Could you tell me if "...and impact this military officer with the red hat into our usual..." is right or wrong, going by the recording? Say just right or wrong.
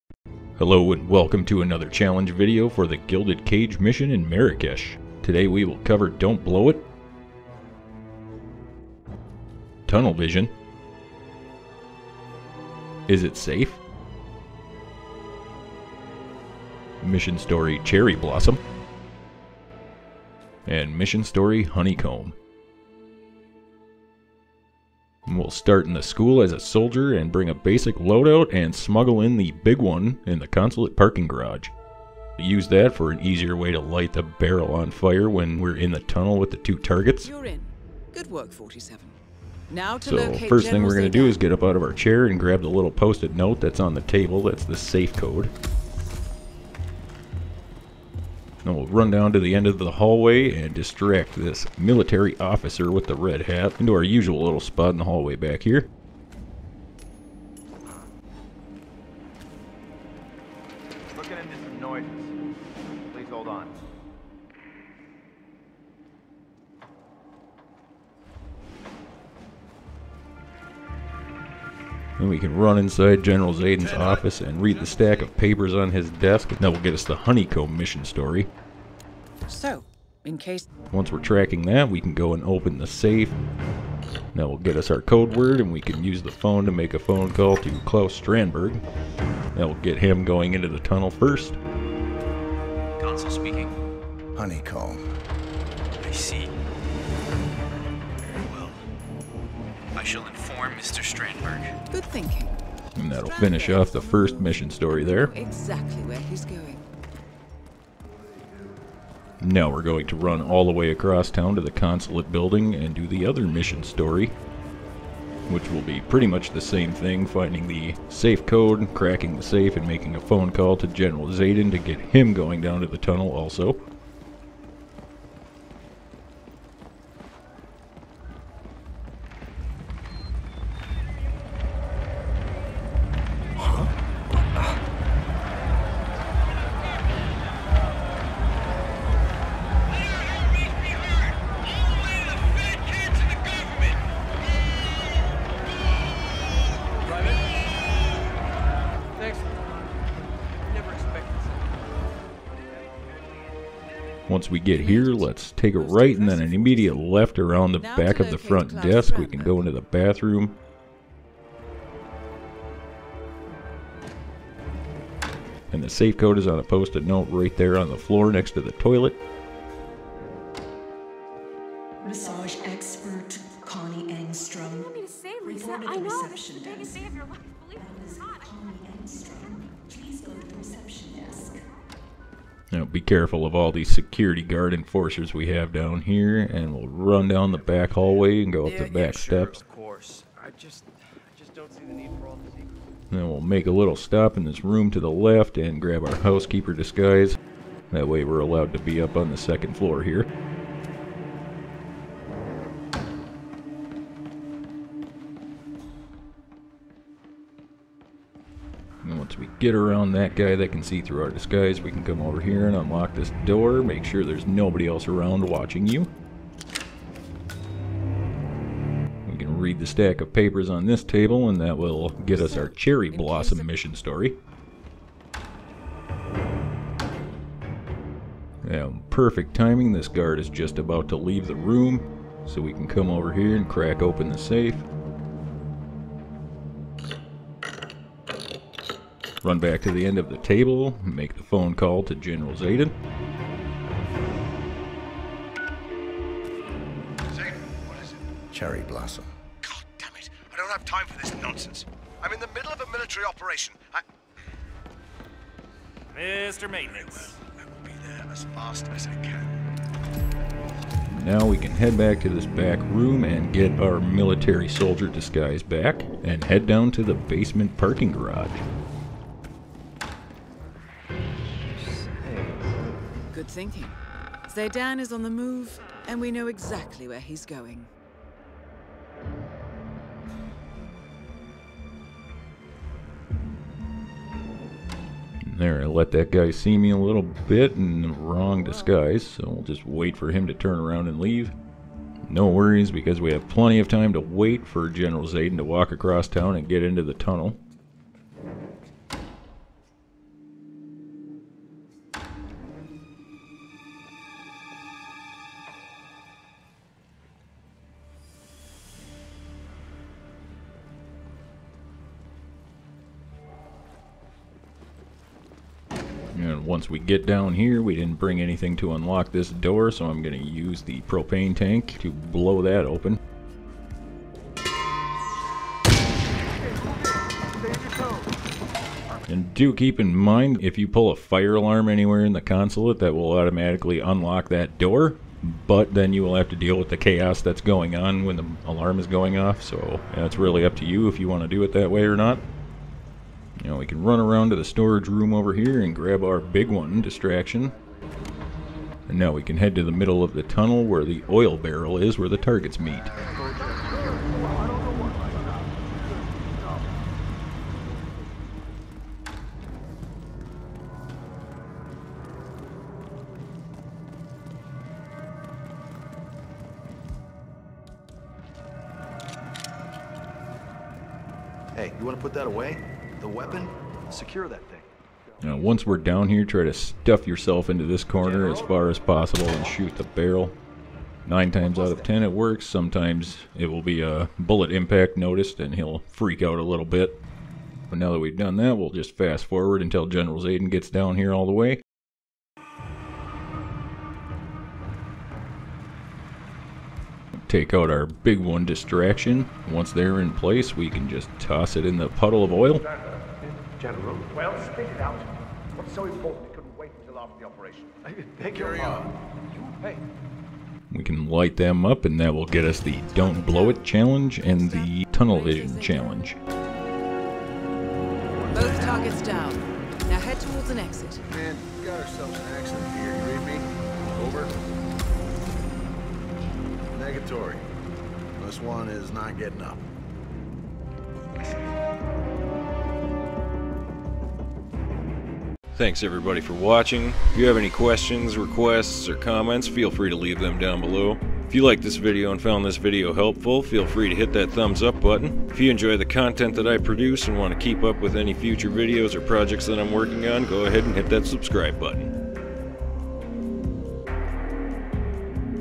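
wrong.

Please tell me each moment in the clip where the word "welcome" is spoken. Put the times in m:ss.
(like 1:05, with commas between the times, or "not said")
0:01.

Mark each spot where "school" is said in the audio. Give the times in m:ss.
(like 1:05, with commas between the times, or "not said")
0:26.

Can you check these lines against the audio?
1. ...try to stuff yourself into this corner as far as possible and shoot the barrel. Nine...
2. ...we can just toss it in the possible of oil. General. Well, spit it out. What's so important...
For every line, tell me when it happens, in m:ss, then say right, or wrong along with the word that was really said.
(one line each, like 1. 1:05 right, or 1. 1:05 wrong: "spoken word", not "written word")
1. 6:16 right
2. 6:40 wrong: "puddle", not "possible".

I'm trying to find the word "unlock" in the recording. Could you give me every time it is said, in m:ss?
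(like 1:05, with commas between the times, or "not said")
3:32, 5:18, 5:33.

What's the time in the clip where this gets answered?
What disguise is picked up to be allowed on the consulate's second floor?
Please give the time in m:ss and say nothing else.
3:16.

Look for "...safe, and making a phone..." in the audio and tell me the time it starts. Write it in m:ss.
1:59.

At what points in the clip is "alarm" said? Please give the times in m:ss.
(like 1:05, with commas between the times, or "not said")
5:31, 5:38.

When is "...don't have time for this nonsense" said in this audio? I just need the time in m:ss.
4:10.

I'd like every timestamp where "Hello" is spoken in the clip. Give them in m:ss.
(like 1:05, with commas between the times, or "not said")
0:00.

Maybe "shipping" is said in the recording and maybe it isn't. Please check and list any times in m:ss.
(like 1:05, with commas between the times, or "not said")
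not said.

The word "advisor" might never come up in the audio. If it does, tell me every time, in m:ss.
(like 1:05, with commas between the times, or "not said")
not said.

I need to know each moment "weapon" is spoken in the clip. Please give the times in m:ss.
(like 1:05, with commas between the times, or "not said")
6:13.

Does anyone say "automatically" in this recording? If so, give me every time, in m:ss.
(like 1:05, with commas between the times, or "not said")
5:33.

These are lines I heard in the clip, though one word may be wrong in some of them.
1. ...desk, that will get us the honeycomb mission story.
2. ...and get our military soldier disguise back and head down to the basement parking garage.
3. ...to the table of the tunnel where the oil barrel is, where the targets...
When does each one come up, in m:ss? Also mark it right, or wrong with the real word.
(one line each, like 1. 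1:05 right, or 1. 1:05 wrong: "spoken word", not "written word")
1. 1:16 right
2. 4:23 right
3. 5:49 wrong: "middle", not "table".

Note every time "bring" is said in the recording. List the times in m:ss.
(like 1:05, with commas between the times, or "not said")
0:27, 5:18.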